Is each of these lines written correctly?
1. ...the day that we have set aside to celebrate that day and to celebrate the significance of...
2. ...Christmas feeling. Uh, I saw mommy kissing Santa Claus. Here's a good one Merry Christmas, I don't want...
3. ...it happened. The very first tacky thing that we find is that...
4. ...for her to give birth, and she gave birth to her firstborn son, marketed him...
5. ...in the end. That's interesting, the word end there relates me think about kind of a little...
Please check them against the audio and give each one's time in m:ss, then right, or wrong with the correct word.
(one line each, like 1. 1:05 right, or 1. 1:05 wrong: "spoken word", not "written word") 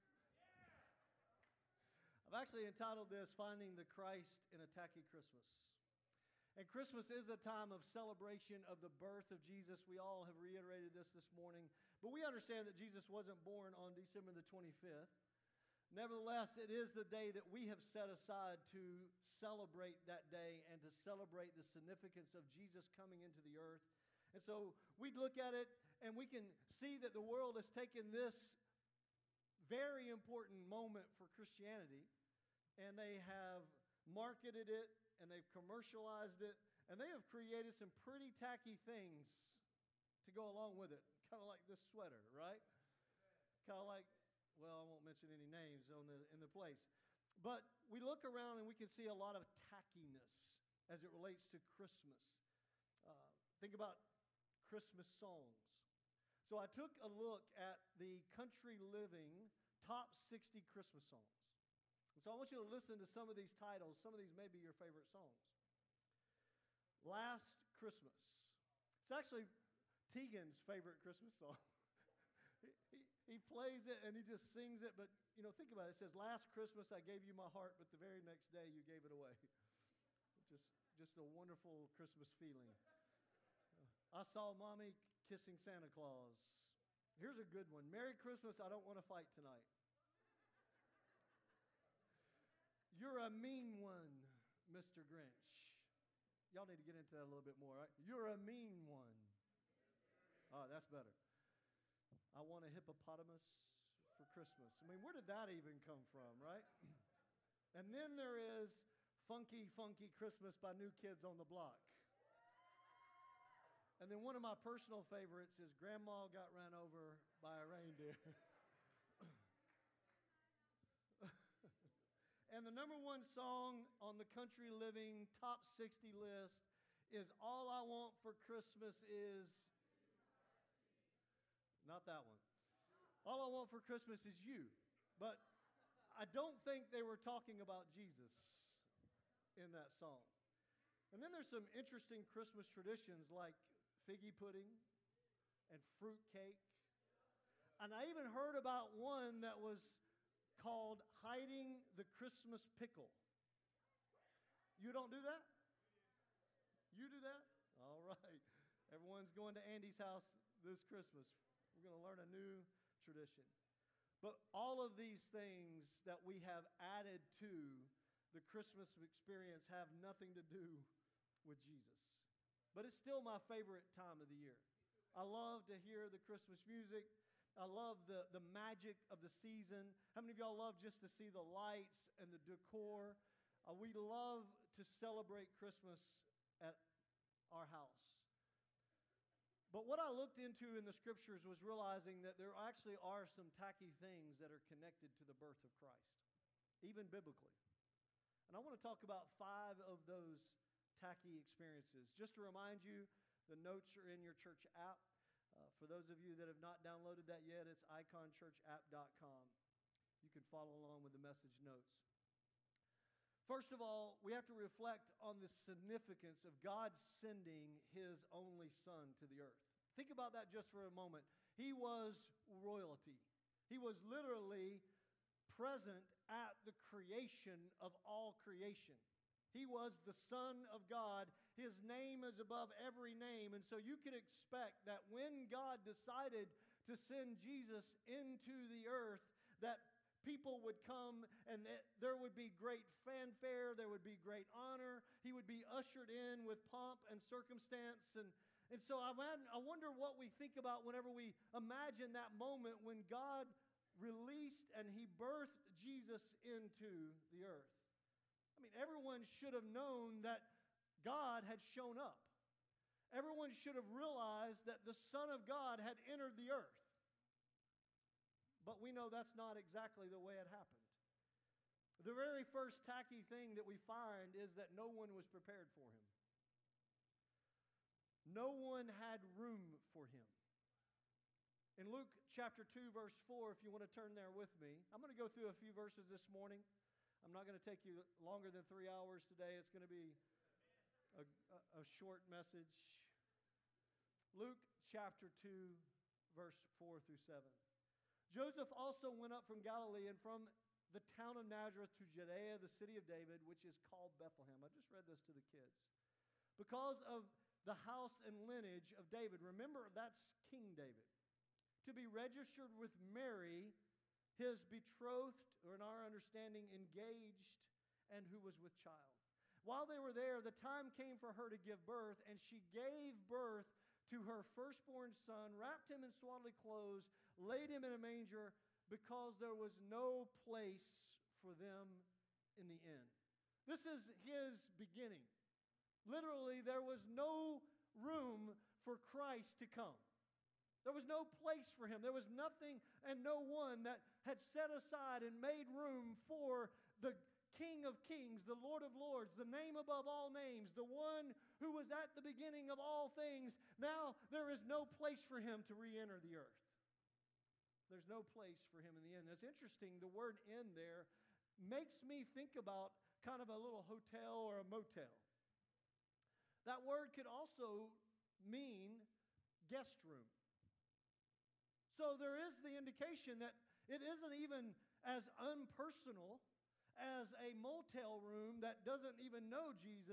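1. 0:16 right
2. 1:21 right
3. 4:30 right
4. 5:21 wrong: "wrapped", not "marketed"
5. 5:58 wrong: "makes", not "relates".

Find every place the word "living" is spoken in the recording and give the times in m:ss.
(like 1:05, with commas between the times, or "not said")
0:58, 2:04.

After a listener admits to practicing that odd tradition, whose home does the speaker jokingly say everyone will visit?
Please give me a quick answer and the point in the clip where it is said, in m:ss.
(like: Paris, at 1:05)
Andy's, at 2:39.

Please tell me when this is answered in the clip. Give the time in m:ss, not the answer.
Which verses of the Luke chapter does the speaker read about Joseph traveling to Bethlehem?
4:56.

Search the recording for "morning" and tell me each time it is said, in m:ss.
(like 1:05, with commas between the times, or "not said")
0:11, 4:46.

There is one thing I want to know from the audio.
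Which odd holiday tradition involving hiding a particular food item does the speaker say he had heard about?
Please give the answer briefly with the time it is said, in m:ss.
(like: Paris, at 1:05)
Christmas pickle, at 2:31.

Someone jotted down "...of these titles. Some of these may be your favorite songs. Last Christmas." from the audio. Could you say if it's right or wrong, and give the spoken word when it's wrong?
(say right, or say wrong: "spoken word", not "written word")
right.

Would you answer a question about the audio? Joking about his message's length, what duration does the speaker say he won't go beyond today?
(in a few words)
three hours.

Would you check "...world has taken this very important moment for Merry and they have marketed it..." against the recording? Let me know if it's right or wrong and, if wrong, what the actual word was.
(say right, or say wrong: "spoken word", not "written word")
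wrong: "Christianity", not "Merry".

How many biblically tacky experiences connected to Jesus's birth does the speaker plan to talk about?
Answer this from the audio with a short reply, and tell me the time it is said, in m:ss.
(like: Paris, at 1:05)
5, at 3:19.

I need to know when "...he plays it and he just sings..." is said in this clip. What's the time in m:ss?
1:13.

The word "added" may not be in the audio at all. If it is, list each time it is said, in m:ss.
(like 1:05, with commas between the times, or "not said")
2:46.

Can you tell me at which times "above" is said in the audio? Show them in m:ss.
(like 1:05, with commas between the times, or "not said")
3:52, 5:49.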